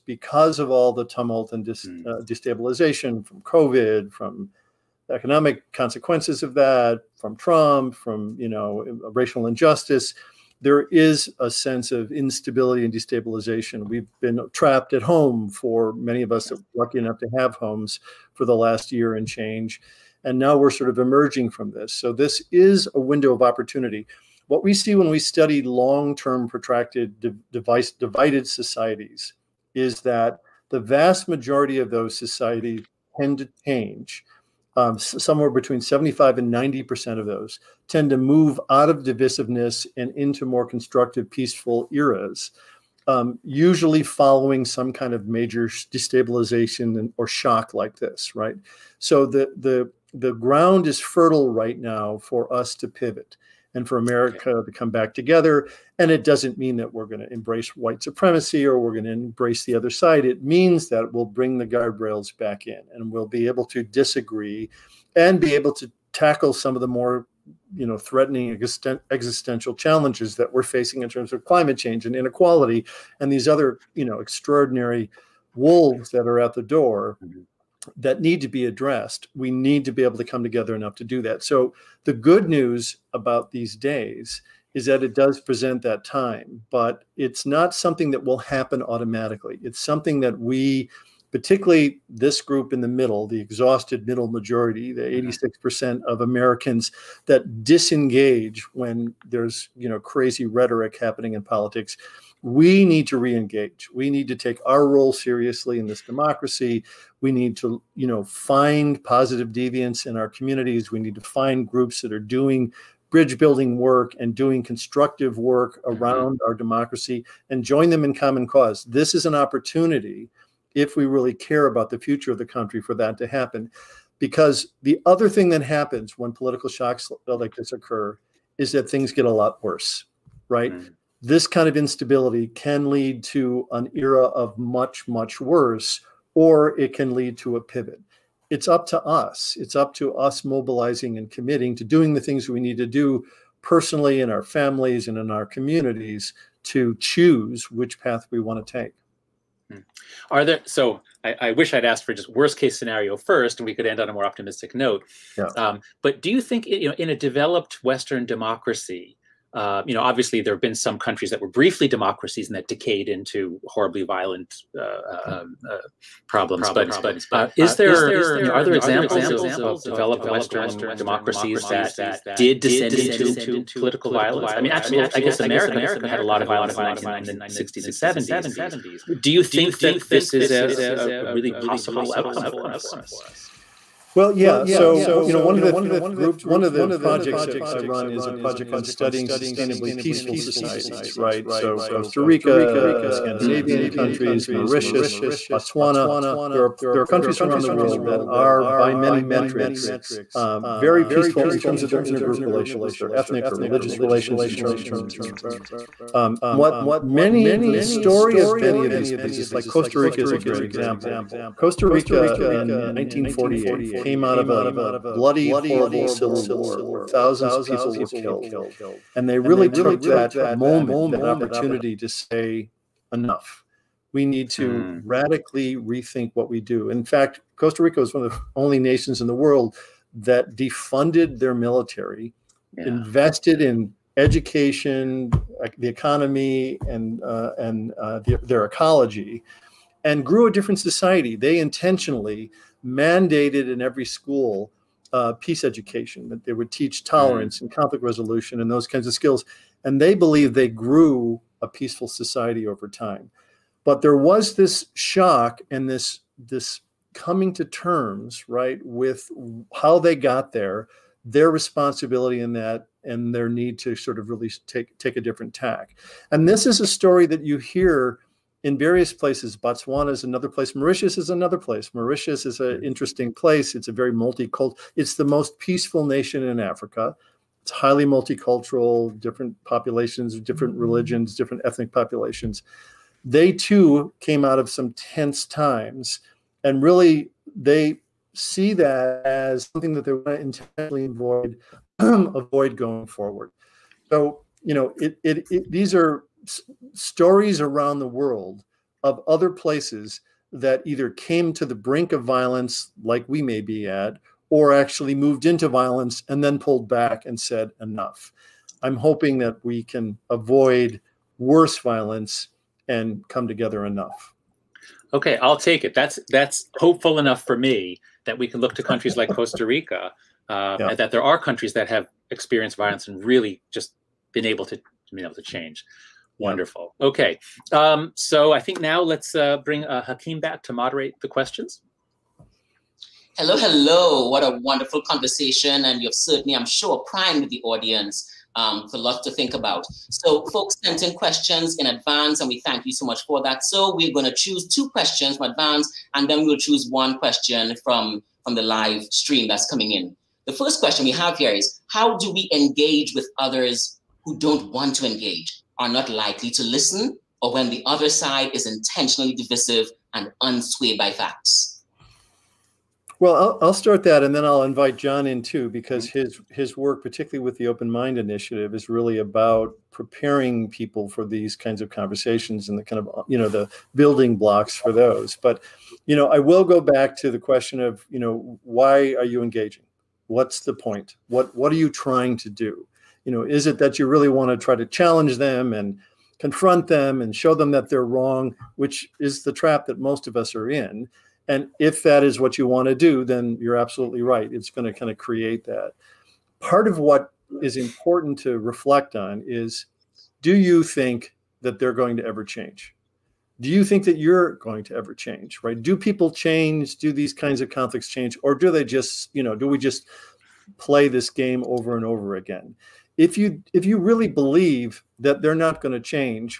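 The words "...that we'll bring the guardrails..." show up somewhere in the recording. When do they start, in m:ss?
1:00.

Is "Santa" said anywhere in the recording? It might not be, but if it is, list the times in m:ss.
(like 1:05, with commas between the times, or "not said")
not said.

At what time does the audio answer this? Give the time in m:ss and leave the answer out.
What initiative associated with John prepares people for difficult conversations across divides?
6:07.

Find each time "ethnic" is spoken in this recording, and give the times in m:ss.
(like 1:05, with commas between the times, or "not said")
3:23, 4:41.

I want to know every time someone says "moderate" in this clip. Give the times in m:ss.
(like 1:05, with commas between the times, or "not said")
5:30.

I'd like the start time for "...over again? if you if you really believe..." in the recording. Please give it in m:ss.
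6:52.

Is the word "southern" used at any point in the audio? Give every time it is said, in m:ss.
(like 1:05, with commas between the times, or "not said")
not said.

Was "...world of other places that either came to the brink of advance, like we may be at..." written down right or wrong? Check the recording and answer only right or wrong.
wrong.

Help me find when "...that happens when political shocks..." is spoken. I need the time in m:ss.
2:05.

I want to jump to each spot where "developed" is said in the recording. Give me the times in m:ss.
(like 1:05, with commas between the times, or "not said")
2:37, 2:49.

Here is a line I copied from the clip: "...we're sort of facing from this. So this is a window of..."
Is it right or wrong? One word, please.
wrong.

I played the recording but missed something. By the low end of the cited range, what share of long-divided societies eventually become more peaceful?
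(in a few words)
75%.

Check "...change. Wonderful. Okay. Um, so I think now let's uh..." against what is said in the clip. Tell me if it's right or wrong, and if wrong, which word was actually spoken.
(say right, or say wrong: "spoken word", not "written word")
right.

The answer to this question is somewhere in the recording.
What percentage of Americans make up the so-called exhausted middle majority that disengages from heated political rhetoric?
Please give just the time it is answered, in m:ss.
1:35.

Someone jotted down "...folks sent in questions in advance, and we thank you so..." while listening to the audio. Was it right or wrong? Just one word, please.
right.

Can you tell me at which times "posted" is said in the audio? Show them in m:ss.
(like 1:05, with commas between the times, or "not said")
not said.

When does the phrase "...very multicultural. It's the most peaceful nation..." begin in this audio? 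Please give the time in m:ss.
4:33.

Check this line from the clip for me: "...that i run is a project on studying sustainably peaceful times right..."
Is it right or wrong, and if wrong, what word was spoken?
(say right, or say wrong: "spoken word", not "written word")
wrong: "societies", not "times".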